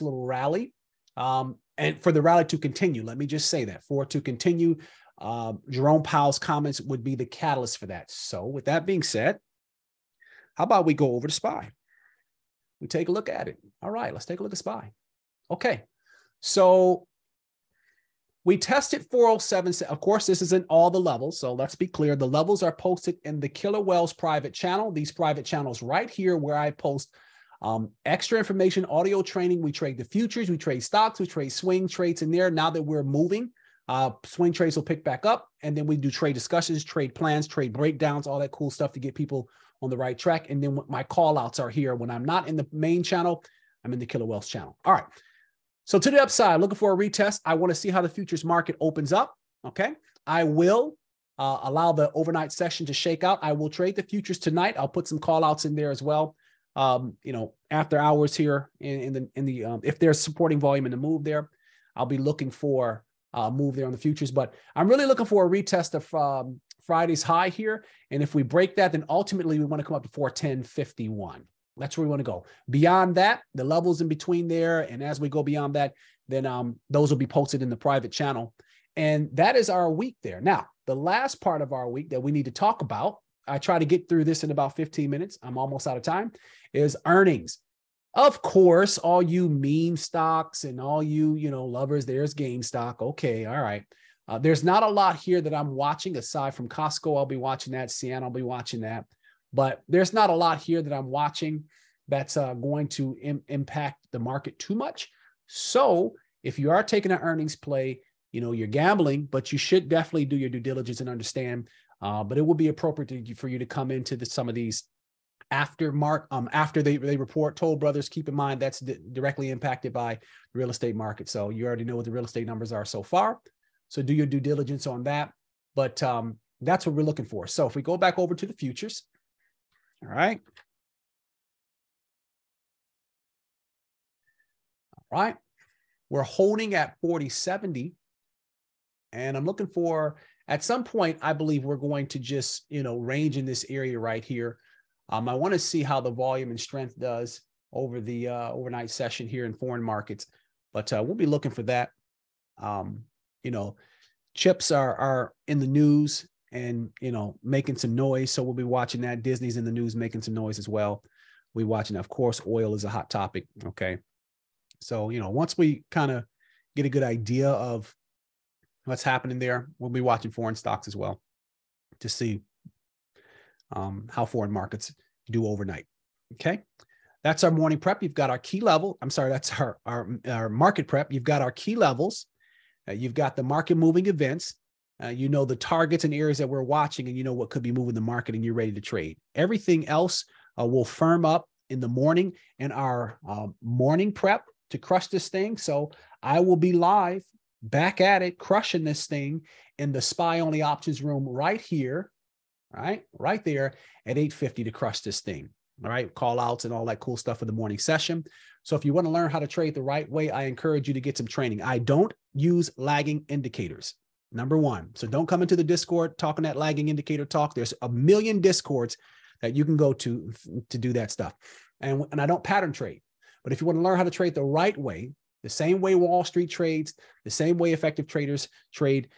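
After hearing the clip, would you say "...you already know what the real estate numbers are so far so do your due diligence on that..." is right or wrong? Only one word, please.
right.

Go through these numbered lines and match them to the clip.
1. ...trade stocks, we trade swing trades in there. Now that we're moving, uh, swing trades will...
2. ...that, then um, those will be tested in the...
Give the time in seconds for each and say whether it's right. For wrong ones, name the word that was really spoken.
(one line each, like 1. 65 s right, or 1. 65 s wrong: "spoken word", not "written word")
1. 30 s right
2. 75 s wrong: "posted", not "tested".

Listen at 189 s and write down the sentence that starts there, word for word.
Everything else uh, will firm up in the morning in our uh, morning prep to crush this thing.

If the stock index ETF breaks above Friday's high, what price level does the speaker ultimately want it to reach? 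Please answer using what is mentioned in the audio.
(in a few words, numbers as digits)
410.51.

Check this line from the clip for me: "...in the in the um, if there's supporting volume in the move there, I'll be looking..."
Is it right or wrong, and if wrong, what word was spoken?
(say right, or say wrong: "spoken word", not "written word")
right.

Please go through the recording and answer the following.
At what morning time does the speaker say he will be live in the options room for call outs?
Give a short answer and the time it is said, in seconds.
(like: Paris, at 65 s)
8:50, at 204 s.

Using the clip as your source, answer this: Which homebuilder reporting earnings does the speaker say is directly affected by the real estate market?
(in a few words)
Toll Brothers.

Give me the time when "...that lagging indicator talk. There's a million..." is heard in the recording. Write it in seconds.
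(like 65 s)
216 s.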